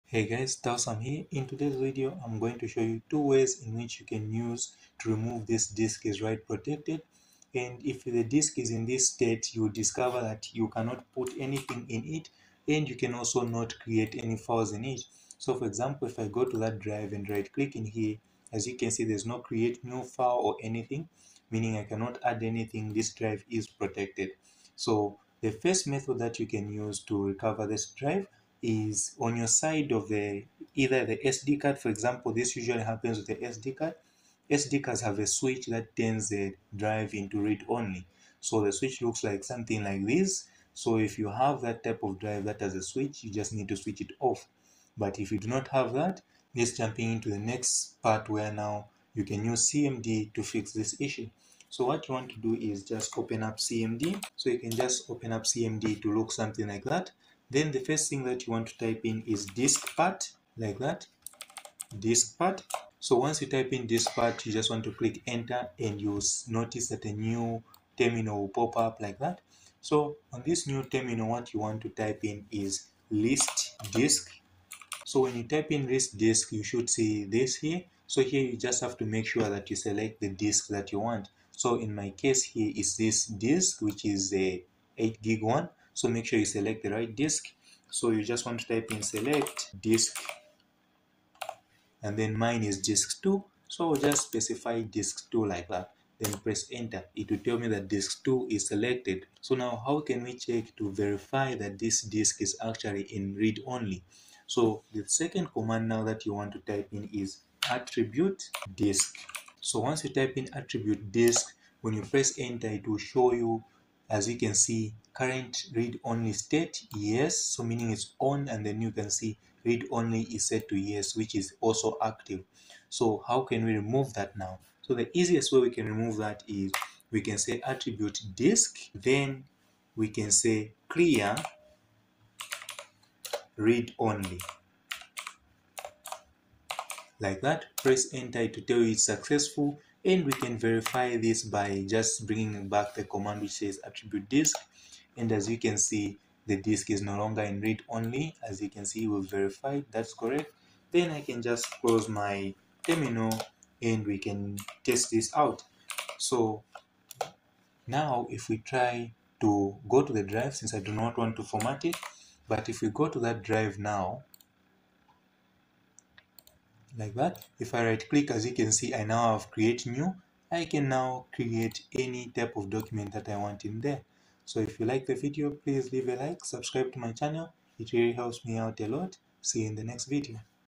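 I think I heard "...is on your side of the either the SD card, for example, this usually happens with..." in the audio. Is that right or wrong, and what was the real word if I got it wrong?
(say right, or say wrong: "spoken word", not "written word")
right.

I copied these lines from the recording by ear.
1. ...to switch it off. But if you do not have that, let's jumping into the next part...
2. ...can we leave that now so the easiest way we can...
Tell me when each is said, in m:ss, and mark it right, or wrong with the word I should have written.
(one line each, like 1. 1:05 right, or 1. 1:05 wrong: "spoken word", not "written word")
1. 0:43 right
2. 2:03 wrong: "remove", not "leave".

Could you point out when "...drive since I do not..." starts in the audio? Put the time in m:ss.
2:40.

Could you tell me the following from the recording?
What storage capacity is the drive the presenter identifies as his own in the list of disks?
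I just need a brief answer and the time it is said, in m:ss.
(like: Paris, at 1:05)
8 gig, at 1:24.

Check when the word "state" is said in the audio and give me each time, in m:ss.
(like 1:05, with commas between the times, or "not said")
0:09, 1:56.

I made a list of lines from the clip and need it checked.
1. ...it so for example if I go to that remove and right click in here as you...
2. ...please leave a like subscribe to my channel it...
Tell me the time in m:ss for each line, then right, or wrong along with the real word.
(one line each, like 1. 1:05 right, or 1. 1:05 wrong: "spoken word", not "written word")
1. 0:14 wrong: "drive", not "remove"
2. 2:55 right.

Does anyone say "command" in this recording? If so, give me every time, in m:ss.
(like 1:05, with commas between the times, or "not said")
1:45, 2:23.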